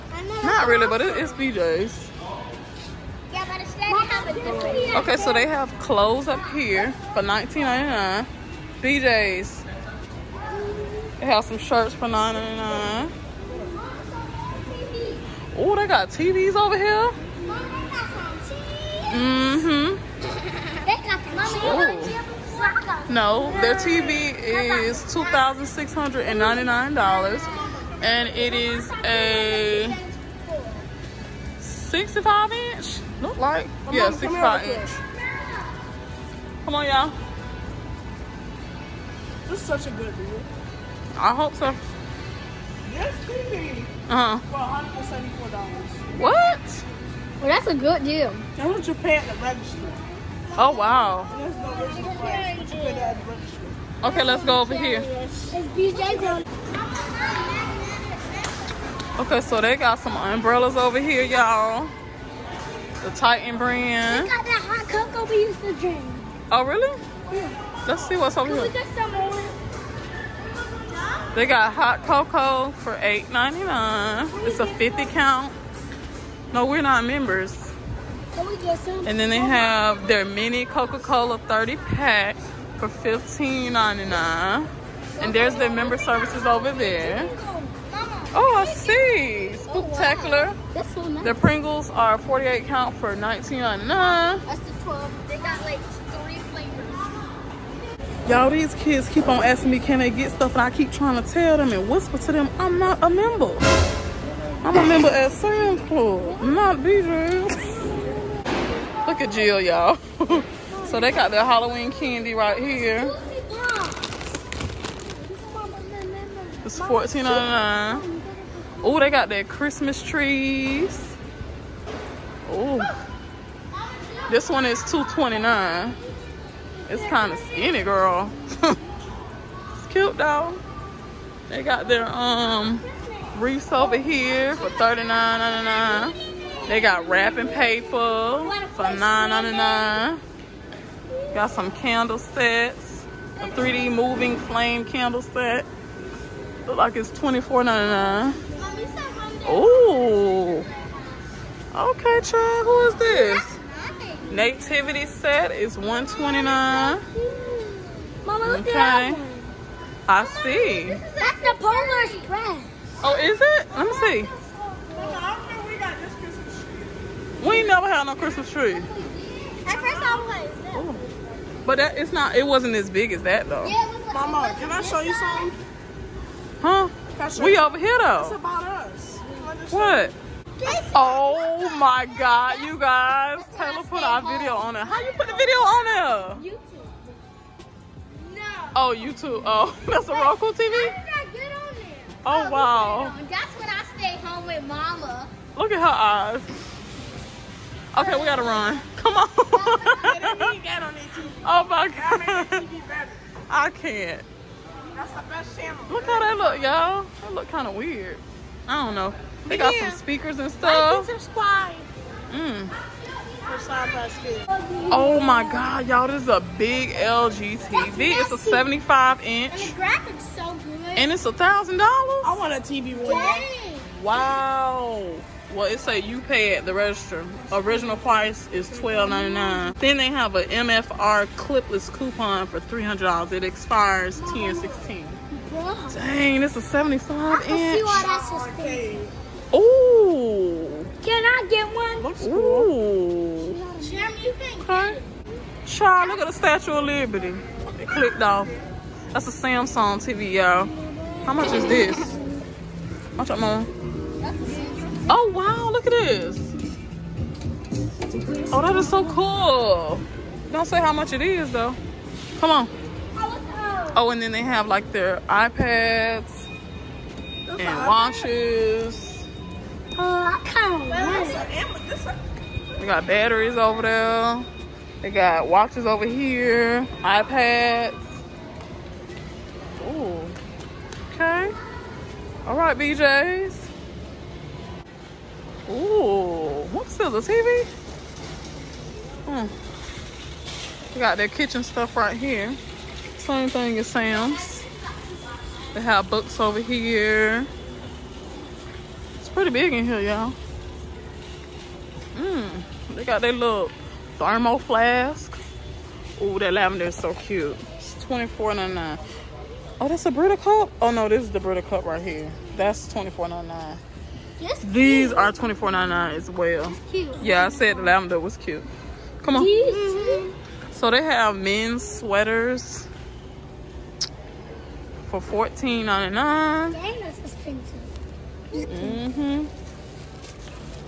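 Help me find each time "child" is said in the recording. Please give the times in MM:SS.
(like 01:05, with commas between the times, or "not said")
02:32, 04:05.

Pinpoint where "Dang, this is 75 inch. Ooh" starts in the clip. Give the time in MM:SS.
03:55.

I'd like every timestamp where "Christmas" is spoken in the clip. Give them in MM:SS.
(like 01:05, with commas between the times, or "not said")
01:59, 02:48.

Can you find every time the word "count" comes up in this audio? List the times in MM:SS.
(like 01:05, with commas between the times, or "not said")
01:15, 01:32.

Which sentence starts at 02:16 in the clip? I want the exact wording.
They got wrapping paper for $9.99.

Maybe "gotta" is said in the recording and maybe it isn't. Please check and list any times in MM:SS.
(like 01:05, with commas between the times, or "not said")
03:18.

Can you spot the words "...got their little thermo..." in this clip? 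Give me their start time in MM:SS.
05:03.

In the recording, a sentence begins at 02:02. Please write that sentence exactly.
Oh, this one is two twenty nine.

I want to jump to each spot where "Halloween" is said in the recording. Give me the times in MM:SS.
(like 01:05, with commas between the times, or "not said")
01:51.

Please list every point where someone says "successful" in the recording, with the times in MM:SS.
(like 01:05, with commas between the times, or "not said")
not said.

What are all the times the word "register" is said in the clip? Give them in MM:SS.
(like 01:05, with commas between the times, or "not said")
00:49, 03:46.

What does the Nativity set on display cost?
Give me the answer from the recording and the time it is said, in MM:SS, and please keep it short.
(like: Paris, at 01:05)
129, at 02:35.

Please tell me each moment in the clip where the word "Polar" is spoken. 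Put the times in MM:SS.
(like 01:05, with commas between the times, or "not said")
02:41.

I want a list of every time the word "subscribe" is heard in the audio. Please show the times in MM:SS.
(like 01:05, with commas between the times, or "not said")
03:31.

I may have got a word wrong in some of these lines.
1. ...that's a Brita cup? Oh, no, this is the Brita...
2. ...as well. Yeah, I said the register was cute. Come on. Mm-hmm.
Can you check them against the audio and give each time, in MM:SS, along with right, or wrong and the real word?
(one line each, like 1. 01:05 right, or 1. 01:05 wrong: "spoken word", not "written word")
1. 05:09 right
2. 05:16 wrong: "lavender", not "register".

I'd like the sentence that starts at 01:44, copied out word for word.
I'm a member at Sam's Club, not BJ's.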